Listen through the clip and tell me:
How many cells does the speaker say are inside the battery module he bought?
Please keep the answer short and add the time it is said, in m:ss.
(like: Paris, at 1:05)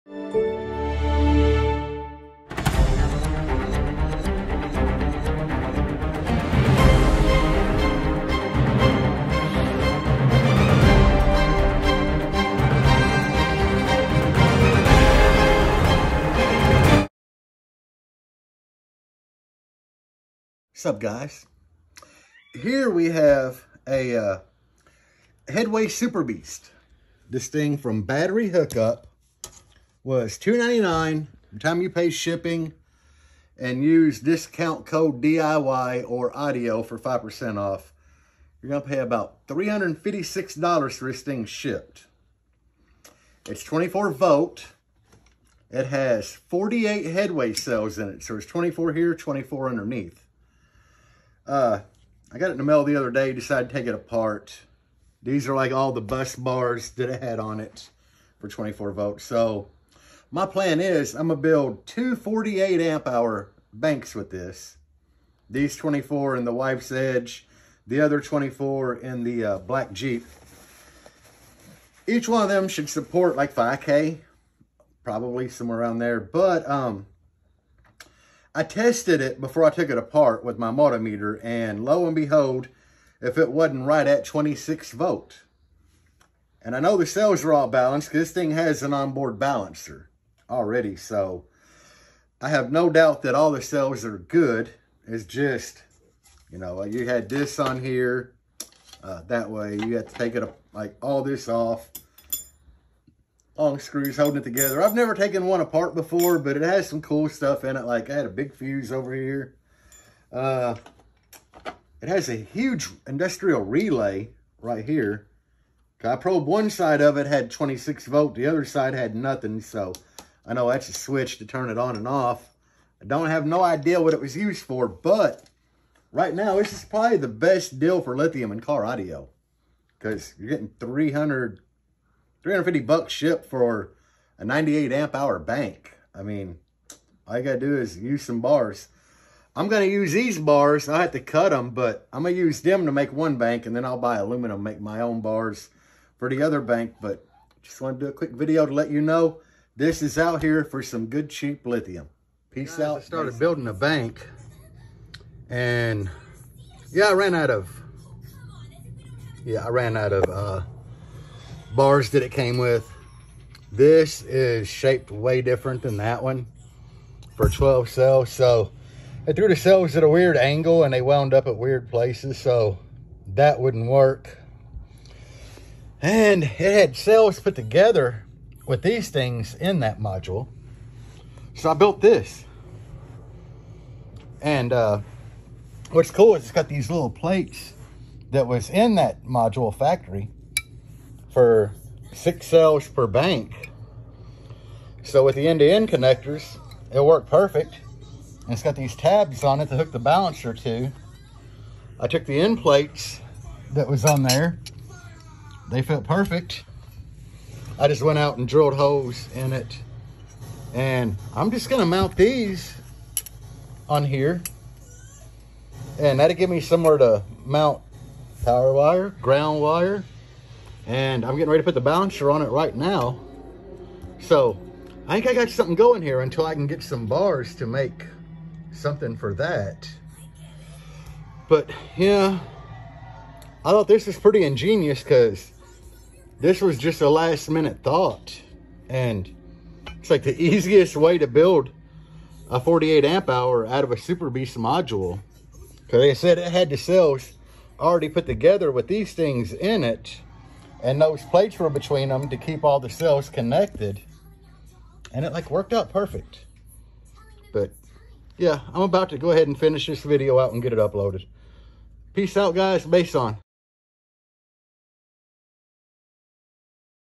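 48, at 0:46.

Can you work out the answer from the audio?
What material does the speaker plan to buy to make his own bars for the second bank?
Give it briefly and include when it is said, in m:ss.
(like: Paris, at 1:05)
aluminum, at 2:24.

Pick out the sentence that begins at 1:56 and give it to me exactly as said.
I probed one side of it had 26 volt.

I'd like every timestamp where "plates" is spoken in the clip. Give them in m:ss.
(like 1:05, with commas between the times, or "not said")
3:07, 3:22, 4:11.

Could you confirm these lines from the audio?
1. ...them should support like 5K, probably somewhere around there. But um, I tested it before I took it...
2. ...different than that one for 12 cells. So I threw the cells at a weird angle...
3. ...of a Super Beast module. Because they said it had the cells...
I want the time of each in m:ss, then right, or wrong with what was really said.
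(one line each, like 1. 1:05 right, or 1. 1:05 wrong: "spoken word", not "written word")
1. 1:12 right
2. 2:45 right
3. 4:03 right.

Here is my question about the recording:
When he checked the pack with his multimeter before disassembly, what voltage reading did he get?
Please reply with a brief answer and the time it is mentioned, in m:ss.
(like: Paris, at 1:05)
26 volt, at 1:23.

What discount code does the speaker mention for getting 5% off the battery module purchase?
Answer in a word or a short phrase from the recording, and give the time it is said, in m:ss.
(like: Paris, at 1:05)
DIY or audio, at 0:35.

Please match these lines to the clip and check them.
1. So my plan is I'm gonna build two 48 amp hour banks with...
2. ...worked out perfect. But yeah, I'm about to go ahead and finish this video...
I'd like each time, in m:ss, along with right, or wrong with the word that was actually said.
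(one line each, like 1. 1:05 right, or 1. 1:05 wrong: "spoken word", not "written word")
1. 0:59 right
2. 4:15 right.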